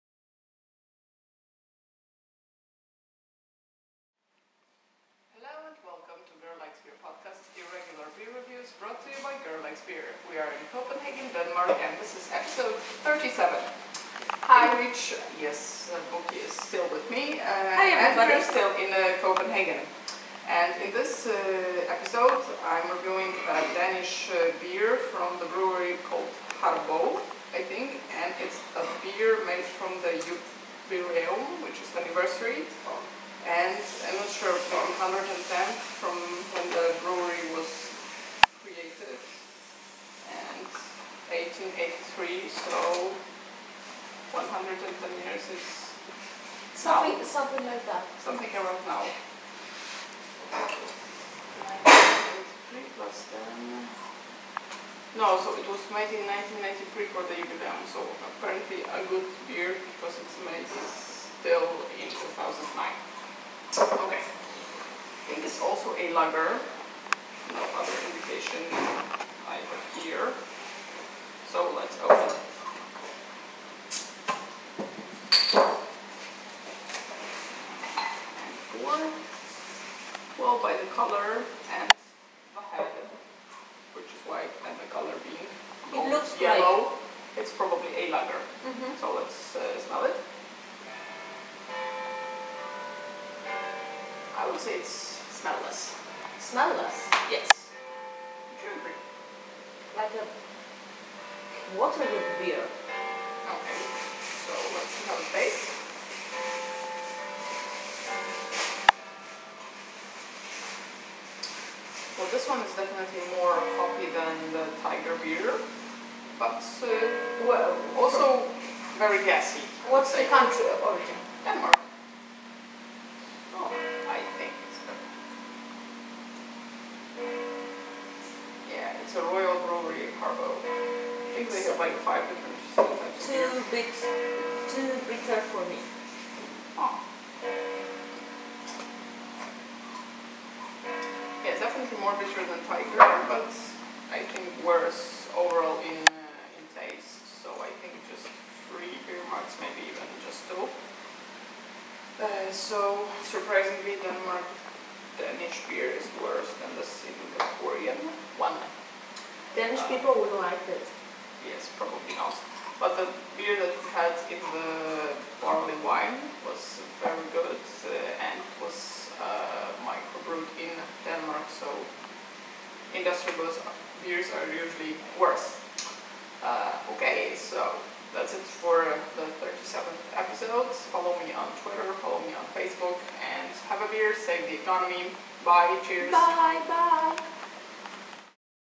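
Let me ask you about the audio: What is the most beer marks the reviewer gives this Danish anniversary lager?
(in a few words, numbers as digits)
3.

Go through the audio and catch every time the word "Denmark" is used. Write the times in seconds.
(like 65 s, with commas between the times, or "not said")
11 s, 121 s, 154 s.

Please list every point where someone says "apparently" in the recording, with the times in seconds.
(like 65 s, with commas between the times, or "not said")
58 s.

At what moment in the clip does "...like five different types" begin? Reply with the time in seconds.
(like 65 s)
131 s.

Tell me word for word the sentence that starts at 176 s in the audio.
Uh, okay, so that's it for the 37th episode.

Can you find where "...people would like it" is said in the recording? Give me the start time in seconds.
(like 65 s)
159 s.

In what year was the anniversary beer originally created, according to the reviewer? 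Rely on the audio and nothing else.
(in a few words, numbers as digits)
1993.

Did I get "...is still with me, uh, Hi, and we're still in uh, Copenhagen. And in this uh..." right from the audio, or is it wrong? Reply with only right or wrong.
right.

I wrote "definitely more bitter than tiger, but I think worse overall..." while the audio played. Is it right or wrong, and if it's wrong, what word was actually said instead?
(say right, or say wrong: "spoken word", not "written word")
right.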